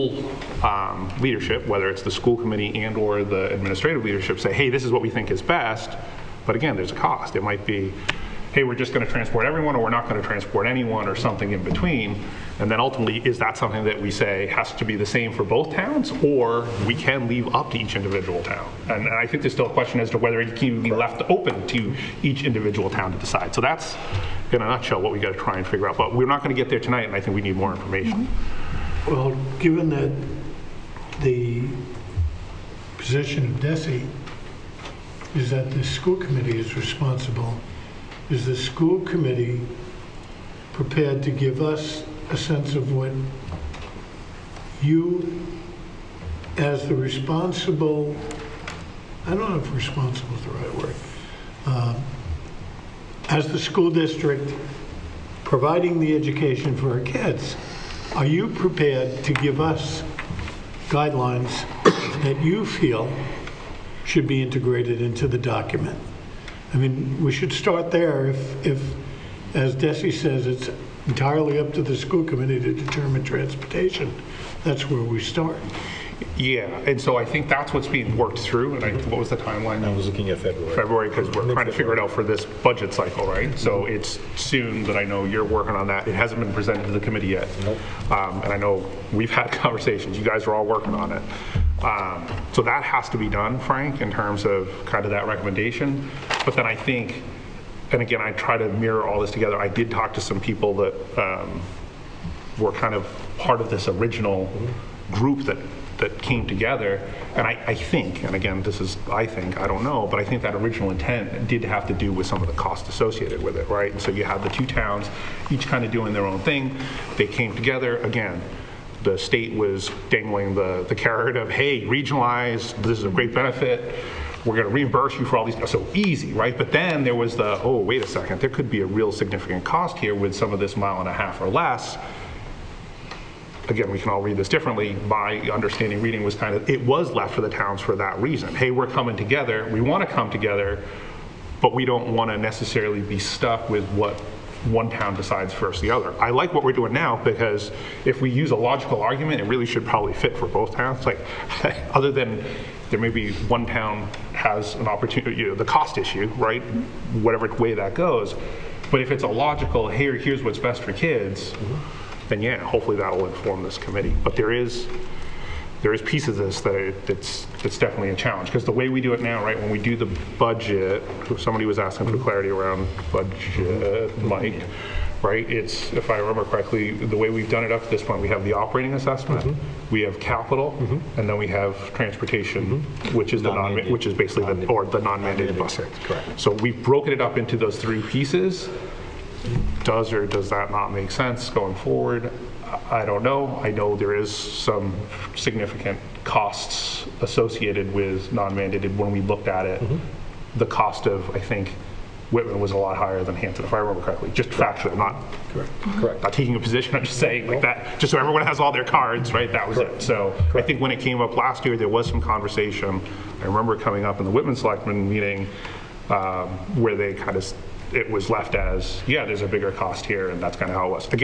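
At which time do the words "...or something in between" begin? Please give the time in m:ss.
0:11.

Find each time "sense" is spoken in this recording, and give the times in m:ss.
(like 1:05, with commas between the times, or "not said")
0:42, 3:11.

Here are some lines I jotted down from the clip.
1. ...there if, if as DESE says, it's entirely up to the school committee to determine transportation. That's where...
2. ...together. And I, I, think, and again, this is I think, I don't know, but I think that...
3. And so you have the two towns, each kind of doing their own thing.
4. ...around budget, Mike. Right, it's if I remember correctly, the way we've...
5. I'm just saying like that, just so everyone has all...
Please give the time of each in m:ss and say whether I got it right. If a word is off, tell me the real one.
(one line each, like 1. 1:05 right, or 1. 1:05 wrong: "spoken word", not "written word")
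1. 1:07 right
2. 1:46 right
3. 1:53 right
4. 2:52 right
5. 3:26 right.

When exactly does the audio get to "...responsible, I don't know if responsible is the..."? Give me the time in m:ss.
0:46.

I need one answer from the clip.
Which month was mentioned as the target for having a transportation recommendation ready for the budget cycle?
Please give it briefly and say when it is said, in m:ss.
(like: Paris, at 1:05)
February, at 1:20.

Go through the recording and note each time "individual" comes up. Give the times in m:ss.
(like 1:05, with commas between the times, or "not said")
0:17, 0:22.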